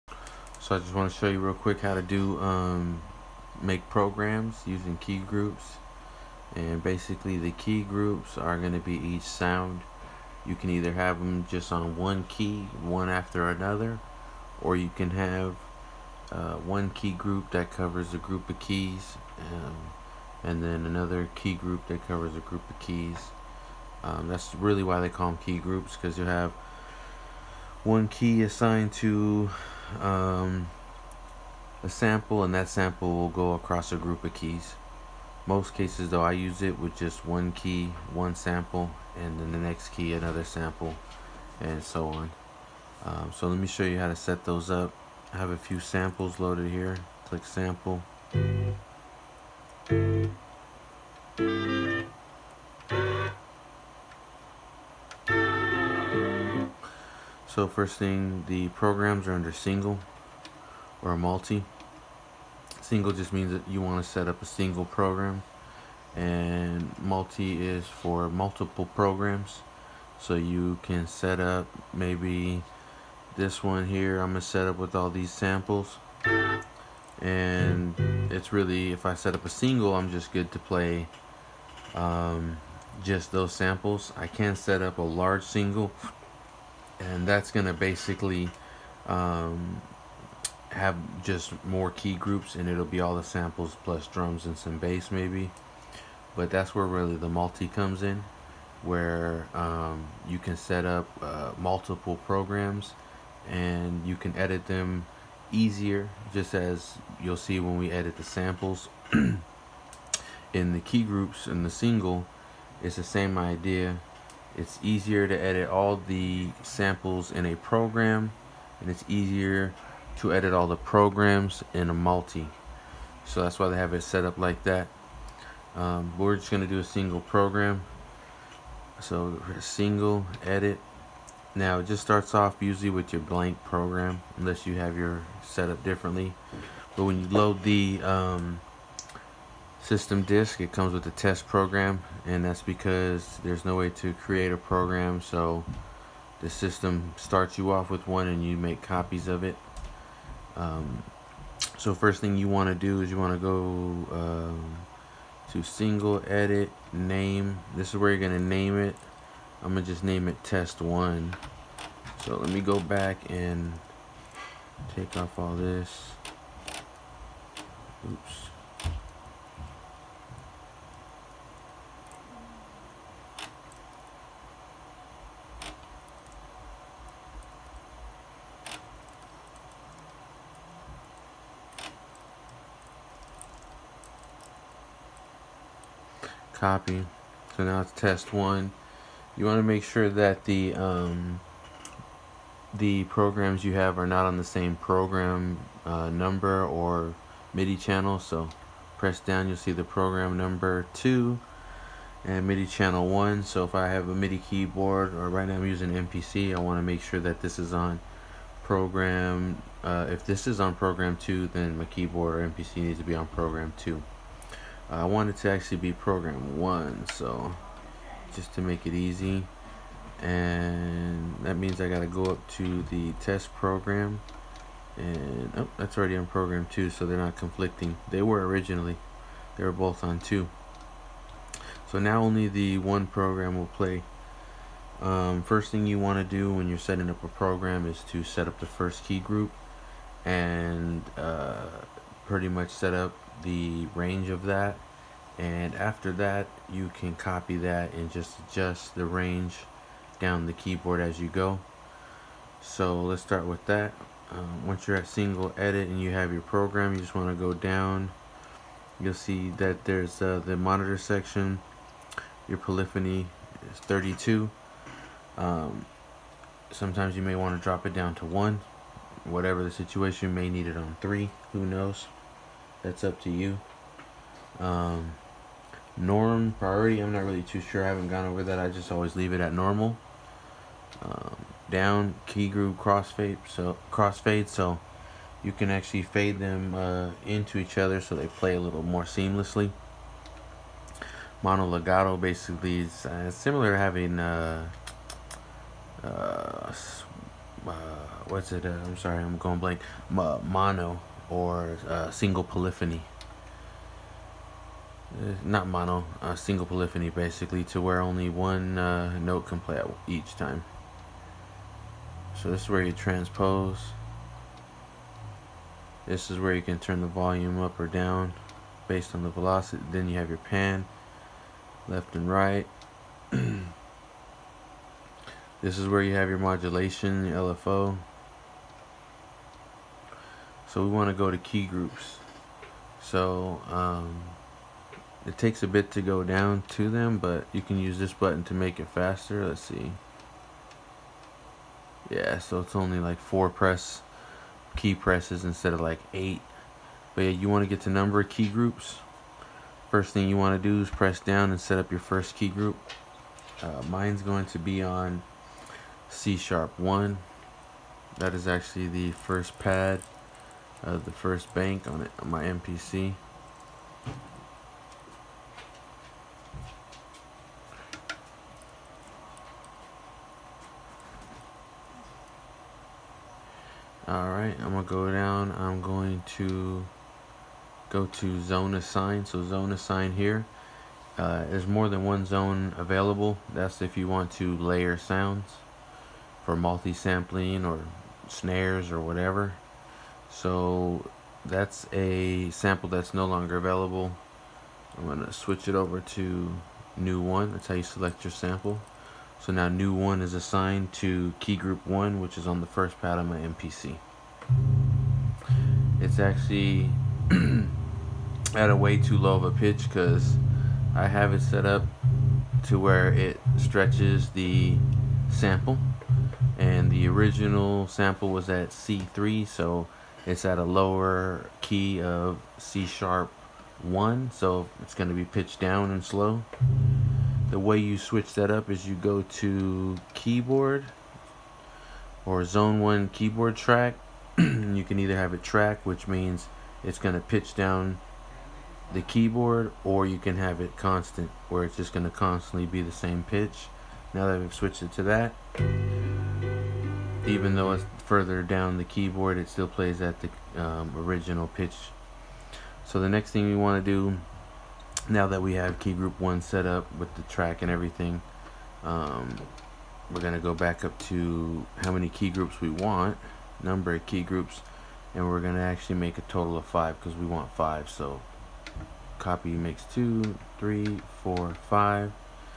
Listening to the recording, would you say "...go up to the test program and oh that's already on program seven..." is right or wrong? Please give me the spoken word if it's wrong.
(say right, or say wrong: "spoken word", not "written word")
wrong: "two", not "seven".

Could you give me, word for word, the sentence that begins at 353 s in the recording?
Uh, mine's going to be on C sharp 1.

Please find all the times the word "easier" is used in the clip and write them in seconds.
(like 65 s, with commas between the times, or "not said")
105 s, 114 s, 119 s.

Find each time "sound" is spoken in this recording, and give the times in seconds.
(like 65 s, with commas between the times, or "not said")
9 s, 384 s.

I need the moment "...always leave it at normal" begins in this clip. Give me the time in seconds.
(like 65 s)
278 s.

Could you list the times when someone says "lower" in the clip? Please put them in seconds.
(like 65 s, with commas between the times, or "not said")
420 s.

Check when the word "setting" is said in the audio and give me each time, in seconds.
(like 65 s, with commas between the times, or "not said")
236 s.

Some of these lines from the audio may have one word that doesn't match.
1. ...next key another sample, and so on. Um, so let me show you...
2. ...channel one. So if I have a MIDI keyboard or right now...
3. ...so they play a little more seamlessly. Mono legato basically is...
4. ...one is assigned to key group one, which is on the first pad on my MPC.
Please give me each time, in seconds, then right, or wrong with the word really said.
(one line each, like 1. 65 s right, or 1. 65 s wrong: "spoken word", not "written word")
1. 39 s right
2. 202 s right
3. 288 s right
4. 399 s right.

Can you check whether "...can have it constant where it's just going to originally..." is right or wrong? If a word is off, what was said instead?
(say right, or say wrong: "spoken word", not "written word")
wrong: "constantly", not "originally".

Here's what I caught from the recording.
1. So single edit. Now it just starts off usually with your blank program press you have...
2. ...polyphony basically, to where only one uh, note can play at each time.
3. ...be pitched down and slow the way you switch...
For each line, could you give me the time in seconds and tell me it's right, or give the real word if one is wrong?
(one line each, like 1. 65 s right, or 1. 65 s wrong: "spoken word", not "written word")
1. 128 s wrong: "unless", not "press"
2. 306 s right
3. 425 s right.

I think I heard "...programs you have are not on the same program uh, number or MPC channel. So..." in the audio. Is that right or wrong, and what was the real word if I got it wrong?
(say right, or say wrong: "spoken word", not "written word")
wrong: "MIDI", not "MPC".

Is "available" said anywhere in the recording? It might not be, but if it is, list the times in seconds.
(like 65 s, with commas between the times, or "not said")
382 s, 393 s.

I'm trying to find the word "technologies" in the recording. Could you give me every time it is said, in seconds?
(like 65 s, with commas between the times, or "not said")
not said.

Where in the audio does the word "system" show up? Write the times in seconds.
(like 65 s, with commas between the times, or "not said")
139 s, 146 s.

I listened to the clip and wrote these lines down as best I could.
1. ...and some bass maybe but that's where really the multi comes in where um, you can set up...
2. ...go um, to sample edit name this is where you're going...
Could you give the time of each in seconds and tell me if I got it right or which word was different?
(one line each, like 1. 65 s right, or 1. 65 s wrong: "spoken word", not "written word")
1. 94 s right
2. 153 s wrong: "single", not "sample".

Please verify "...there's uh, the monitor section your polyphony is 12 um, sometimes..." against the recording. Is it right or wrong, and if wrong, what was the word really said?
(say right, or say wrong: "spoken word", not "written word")
wrong: "32", not "12".